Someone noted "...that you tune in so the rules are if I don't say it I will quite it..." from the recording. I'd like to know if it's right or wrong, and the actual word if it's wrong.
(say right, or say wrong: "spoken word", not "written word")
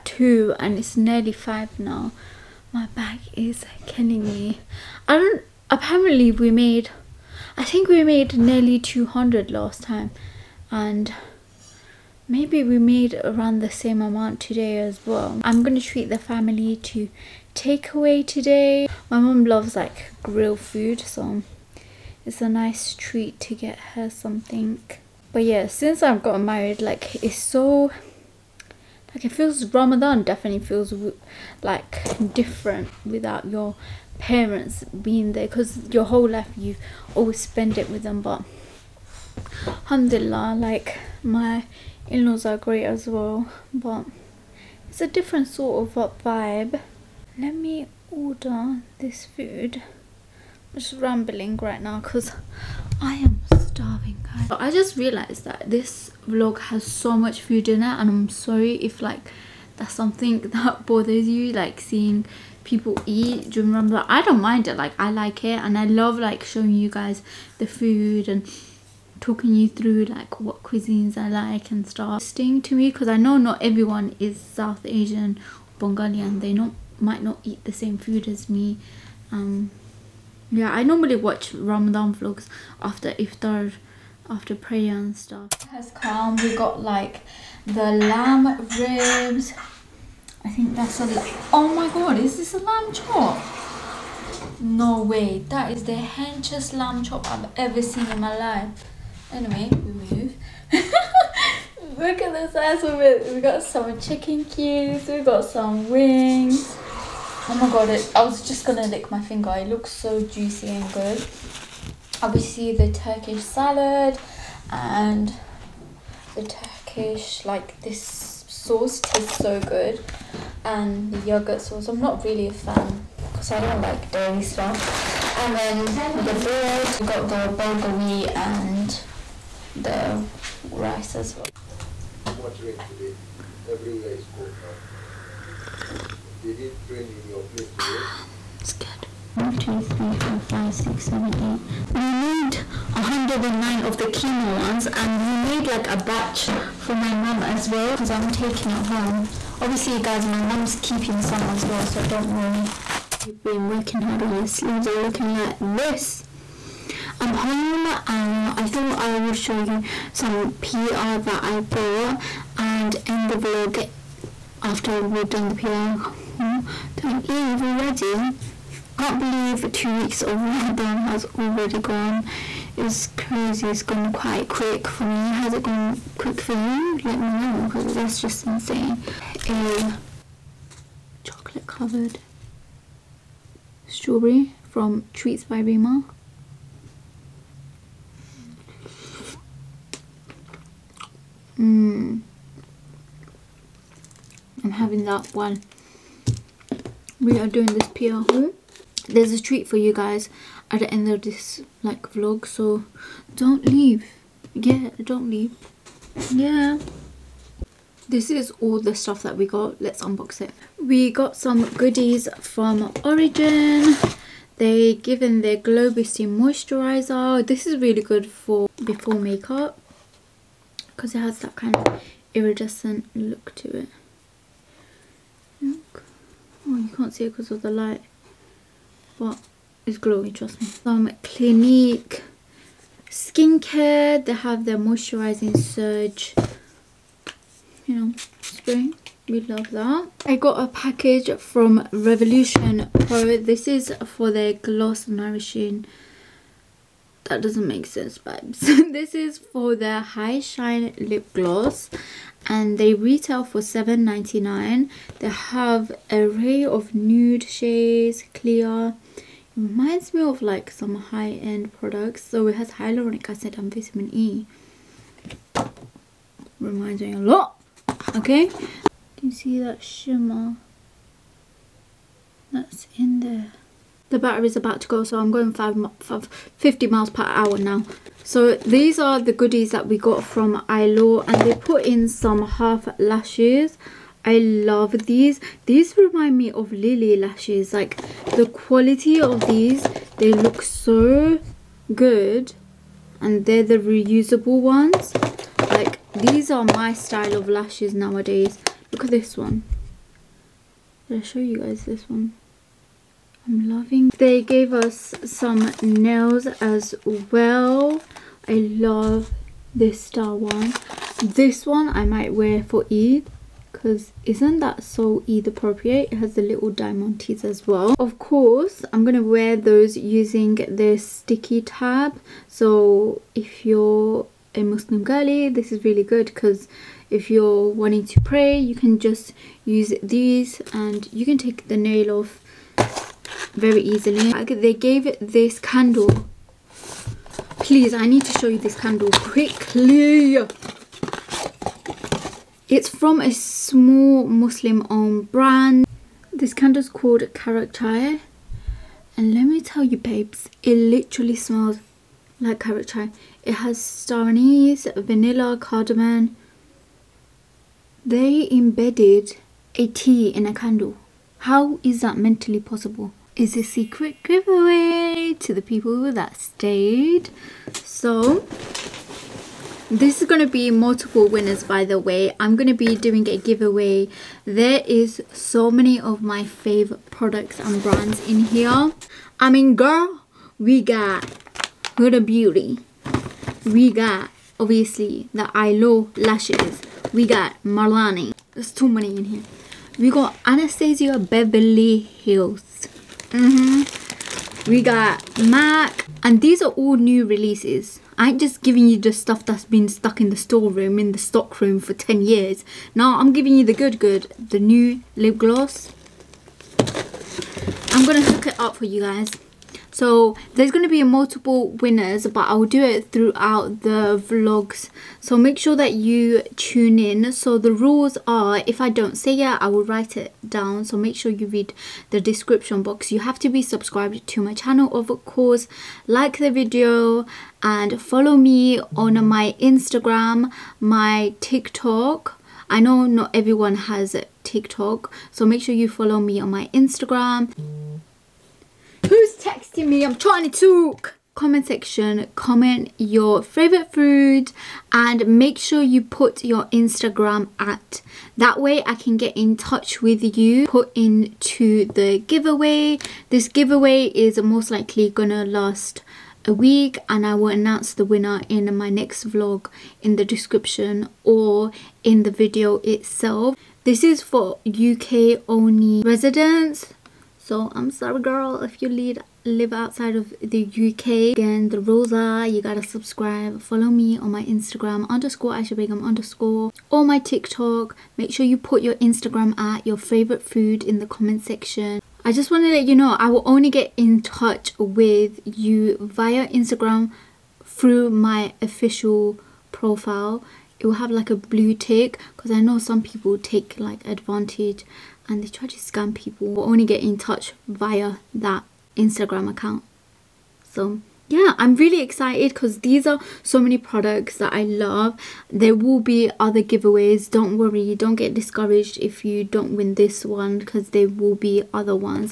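wrong: "write", not "quite".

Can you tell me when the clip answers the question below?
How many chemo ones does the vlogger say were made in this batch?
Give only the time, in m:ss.
2:22.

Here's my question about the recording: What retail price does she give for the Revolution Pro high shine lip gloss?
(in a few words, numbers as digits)
7.99.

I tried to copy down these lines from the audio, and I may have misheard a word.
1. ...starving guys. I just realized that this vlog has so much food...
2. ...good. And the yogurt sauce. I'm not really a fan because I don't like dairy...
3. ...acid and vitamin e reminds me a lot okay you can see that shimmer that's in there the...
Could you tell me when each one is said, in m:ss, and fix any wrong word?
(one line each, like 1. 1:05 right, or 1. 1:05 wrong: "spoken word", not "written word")
1. 0:53 right
2. 1:59 right
3. 4:23 right.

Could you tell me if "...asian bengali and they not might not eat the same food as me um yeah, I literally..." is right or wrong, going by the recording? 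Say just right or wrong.
wrong.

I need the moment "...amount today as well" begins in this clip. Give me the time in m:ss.
0:14.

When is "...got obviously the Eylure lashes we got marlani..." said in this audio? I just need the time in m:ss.
6:23.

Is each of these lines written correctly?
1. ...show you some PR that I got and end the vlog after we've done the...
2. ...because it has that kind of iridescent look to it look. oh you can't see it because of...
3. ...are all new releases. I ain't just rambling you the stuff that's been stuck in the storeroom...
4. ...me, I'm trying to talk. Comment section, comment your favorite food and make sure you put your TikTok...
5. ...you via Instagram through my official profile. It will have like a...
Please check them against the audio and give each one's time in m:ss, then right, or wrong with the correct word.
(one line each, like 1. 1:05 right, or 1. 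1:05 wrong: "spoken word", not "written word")
1. 2:39 right
2. 3:40 right
3. 6:36 wrong: "giving", not "rambling"
4. 7:19 wrong: "Instagram", not "TikTok"
5. 8:05 right.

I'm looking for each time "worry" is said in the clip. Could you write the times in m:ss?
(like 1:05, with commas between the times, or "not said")
2:32, 8:27.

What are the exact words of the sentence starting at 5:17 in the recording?
Of course, I'm going to wear those using this sticky tab.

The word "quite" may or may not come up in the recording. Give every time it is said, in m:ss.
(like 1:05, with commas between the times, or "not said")
2:54.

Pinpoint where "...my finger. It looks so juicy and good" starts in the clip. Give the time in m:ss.
1:49.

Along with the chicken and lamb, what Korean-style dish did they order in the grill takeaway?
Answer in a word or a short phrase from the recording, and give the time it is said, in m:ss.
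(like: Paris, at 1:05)
bulgogi, at 2:07.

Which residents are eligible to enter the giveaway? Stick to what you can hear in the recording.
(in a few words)
UK only.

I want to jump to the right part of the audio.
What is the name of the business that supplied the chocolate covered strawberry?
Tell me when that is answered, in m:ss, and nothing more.
3:05.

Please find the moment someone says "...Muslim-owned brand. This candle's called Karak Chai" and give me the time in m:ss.
5:44.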